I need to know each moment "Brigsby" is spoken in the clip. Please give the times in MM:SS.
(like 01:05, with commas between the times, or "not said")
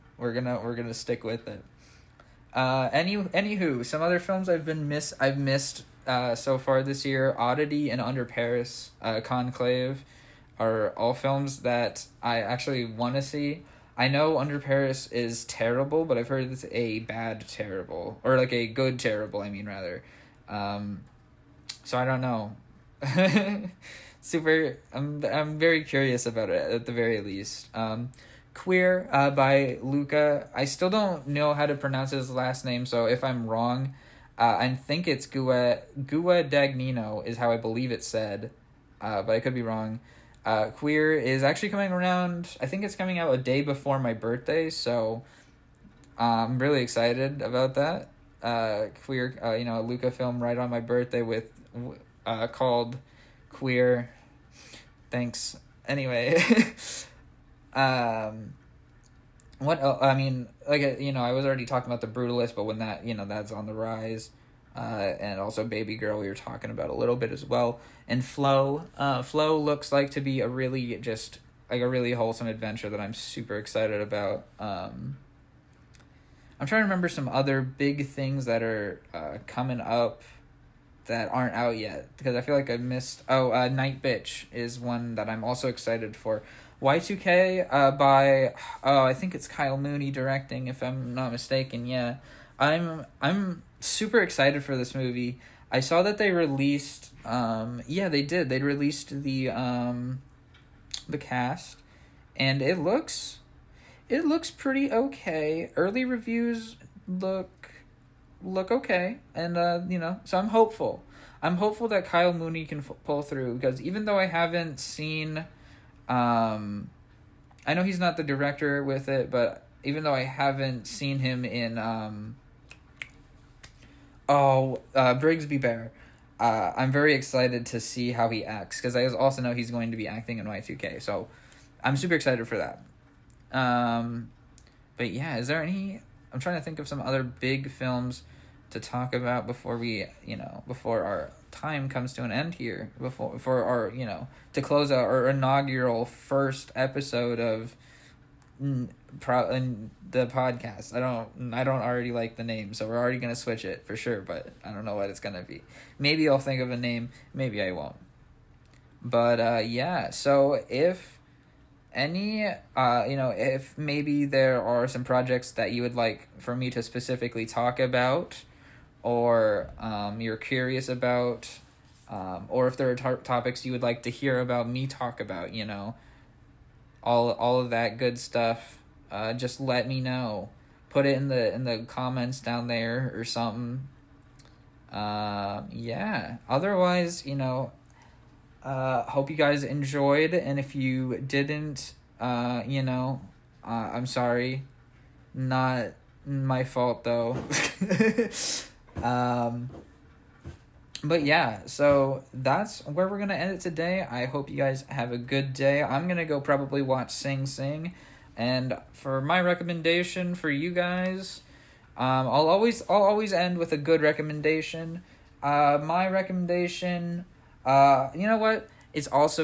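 02:05.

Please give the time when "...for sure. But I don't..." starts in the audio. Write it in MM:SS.
02:33.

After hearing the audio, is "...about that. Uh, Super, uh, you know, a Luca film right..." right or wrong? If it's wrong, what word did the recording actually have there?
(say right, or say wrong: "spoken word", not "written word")
wrong: "Queer", not "Super".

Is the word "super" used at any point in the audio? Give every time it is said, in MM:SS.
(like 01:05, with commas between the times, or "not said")
00:24, 01:13, 01:33, 02:11.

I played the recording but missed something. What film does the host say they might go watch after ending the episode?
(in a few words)
Sing Sing.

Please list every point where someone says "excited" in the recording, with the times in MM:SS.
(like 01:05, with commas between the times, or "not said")
00:46, 01:13, 01:25, 01:34, 02:07, 02:12.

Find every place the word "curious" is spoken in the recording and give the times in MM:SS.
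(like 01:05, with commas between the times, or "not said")
00:25, 02:50.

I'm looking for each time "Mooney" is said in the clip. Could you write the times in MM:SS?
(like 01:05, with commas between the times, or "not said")
01:29, 01:52.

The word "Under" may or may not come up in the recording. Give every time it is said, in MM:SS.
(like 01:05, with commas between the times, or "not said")
00:08, 00:14.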